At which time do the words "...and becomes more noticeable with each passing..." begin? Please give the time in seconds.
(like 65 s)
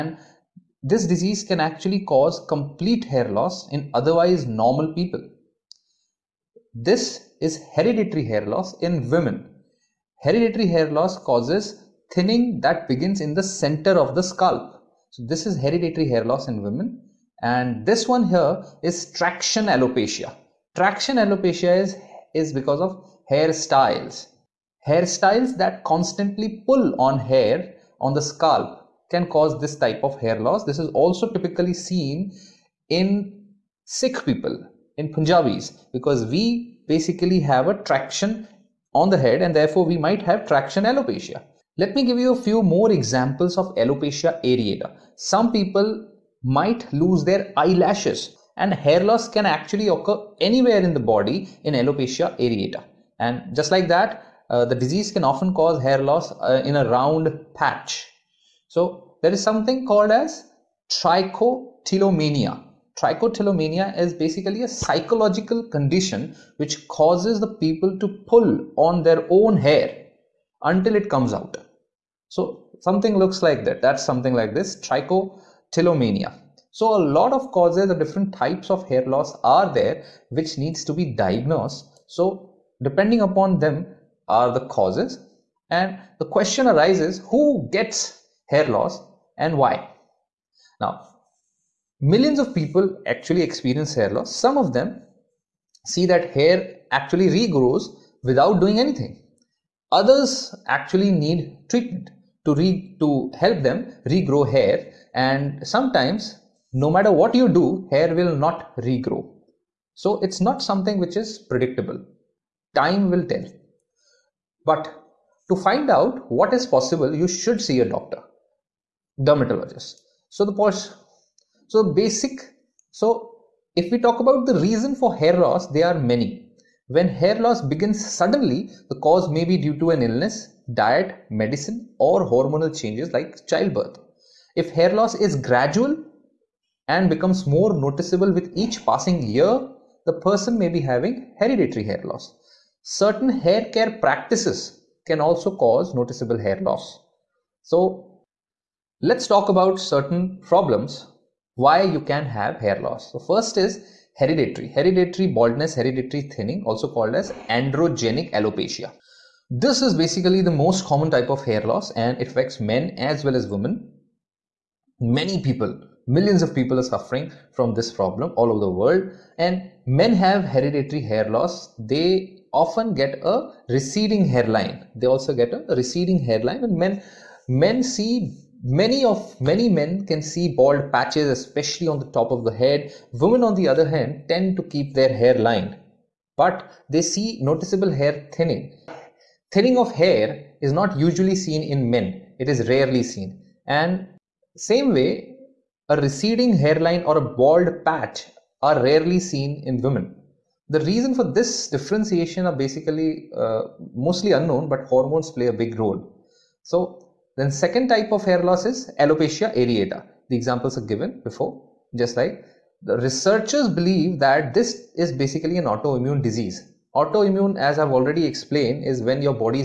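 136 s.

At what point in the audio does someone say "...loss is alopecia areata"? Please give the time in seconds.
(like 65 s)
208 s.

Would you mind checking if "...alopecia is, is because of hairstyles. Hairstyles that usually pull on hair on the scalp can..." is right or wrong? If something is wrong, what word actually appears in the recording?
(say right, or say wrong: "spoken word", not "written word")
wrong: "constantly", not "usually".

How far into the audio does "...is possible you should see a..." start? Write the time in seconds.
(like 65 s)
116 s.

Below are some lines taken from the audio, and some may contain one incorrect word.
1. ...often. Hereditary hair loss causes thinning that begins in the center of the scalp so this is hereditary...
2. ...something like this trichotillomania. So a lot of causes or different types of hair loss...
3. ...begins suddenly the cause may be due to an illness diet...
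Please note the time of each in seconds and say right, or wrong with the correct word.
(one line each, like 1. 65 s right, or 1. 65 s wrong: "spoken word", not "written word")
1. 9 s wrong: "women", not "often"
2. 74 s right
3. 127 s right.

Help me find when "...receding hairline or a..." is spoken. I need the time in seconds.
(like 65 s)
195 s.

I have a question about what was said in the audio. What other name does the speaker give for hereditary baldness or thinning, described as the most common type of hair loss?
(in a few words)
Androgenic alopecia.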